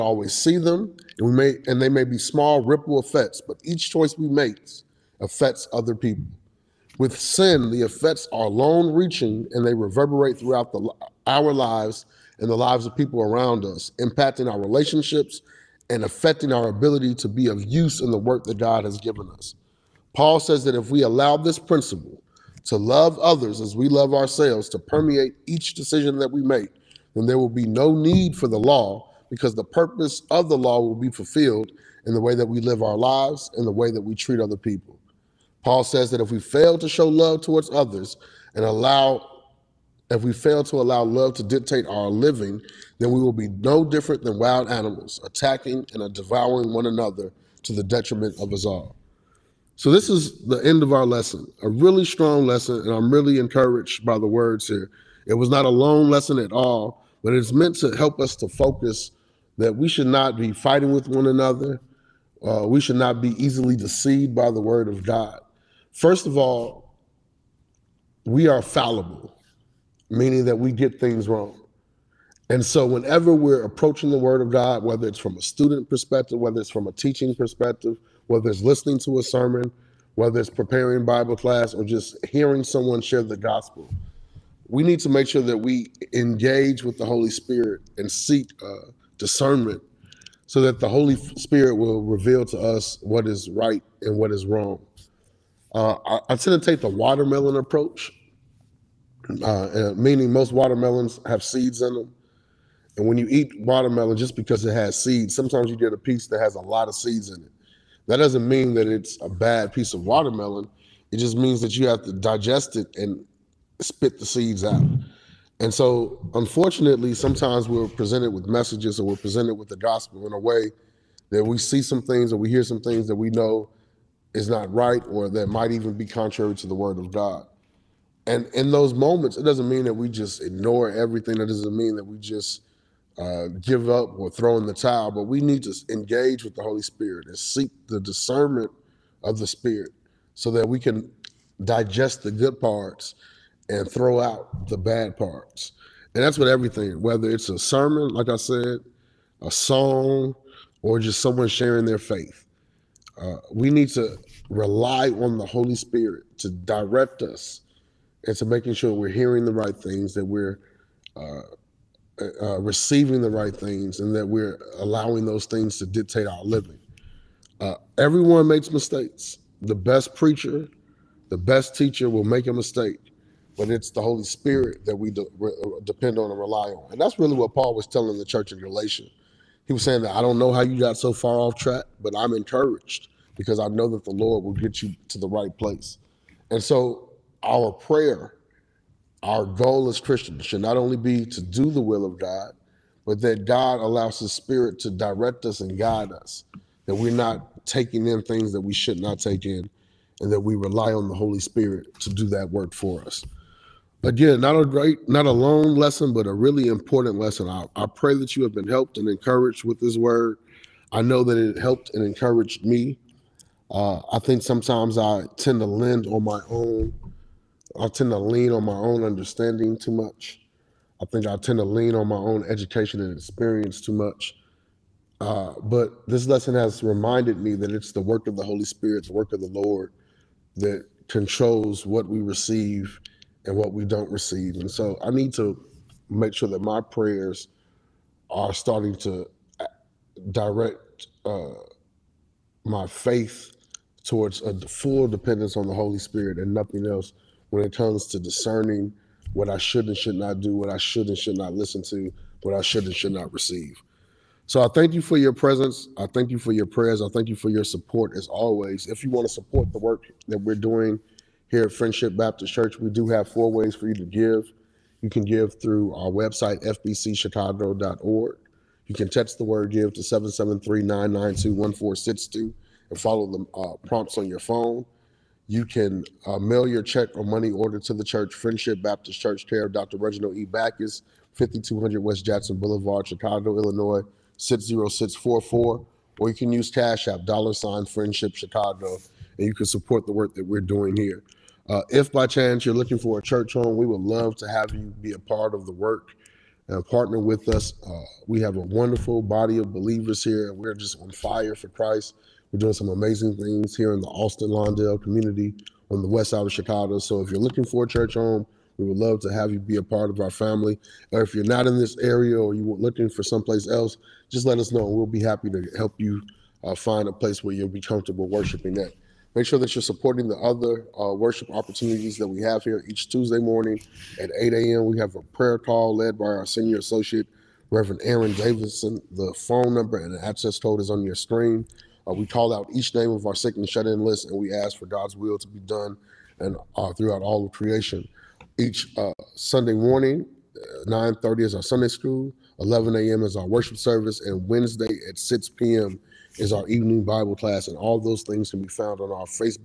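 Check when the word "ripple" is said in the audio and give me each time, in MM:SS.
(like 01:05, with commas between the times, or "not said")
00:02.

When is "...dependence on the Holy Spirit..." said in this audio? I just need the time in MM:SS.
04:05.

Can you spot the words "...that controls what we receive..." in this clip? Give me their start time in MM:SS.
03:50.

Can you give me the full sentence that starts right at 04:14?
So I thank you for your presence.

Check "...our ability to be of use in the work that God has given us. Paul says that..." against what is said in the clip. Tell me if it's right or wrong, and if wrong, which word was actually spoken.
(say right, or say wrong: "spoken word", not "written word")
right.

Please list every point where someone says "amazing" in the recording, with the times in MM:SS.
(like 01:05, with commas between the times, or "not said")
05:02.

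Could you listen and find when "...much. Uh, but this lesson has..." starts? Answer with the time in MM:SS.
03:43.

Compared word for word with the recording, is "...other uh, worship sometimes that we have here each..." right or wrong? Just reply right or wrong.
wrong.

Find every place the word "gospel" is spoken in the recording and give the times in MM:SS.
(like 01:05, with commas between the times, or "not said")
01:23, 01:59.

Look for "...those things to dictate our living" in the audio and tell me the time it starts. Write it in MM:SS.
02:45.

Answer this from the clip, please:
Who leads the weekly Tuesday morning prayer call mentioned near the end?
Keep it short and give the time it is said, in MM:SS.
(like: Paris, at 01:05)
Reverend Aaron Davidson, at 05:27.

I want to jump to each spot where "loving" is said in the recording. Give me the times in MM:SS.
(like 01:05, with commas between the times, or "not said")
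not said.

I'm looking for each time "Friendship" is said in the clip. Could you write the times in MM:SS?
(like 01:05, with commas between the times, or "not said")
04:21, 04:38, 04:47.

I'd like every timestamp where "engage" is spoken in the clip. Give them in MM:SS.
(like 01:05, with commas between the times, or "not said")
01:26, 02:15.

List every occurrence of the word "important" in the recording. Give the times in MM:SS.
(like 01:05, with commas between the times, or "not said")
03:26.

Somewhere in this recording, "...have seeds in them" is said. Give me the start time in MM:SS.
01:41.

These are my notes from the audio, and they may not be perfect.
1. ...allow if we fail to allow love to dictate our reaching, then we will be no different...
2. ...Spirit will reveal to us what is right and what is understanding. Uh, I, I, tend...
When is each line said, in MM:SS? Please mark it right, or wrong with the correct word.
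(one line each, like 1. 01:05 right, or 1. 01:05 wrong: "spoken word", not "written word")
1. 00:38 wrong: "living", not "reaching"
2. 01:31 wrong: "wrong", not "understanding".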